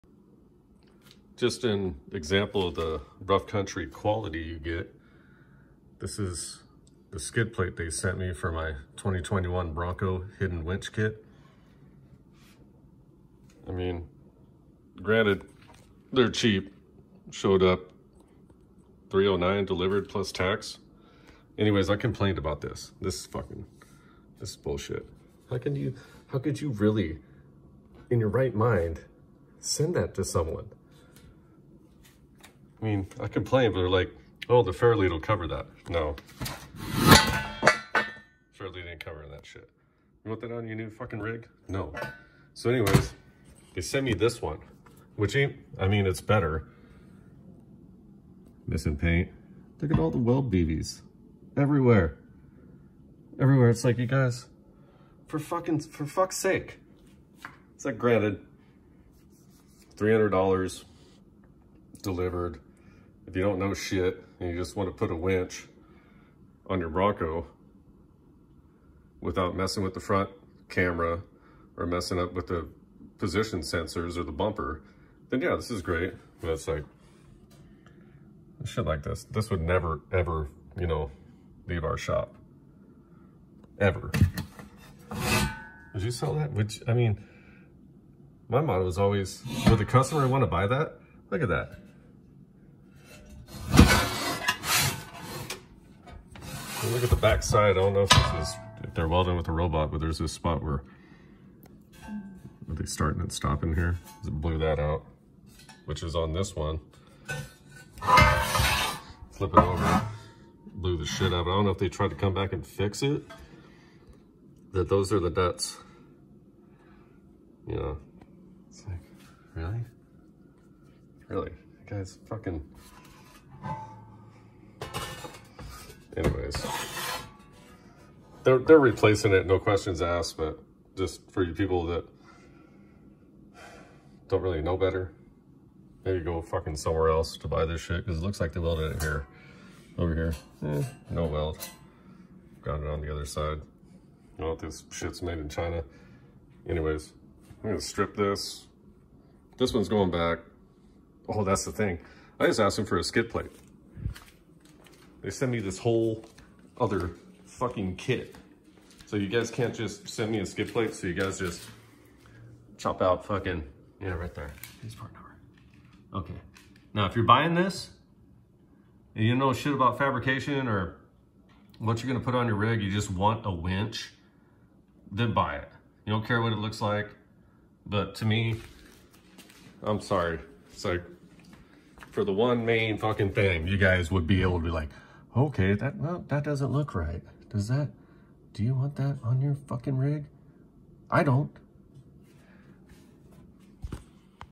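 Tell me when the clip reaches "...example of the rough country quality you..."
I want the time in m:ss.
0:02.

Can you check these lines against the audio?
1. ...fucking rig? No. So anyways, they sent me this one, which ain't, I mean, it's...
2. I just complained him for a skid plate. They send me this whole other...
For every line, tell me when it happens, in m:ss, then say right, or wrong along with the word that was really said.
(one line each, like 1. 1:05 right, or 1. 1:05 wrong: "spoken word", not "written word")
1. 0:40 right
2. 2:32 wrong: "asked", not "complained".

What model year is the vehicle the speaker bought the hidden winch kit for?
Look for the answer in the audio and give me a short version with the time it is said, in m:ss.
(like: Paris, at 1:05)
2021, at 0:08.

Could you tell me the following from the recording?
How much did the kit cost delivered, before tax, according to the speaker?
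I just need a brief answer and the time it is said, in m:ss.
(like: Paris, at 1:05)
309, at 0:19.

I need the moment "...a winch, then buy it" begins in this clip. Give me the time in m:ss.
2:53.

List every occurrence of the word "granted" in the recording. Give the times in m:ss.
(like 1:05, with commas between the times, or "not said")
0:15, 0:57.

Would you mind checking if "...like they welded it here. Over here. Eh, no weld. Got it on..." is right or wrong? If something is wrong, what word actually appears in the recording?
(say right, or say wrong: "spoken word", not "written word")
right.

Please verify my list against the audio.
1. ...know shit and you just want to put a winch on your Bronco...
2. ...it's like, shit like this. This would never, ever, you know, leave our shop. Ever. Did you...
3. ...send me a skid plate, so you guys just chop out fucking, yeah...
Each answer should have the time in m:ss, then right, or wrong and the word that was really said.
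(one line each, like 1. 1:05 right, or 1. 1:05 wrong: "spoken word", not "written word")
1. 1:03 right
2. 1:16 right
3. 2:40 right.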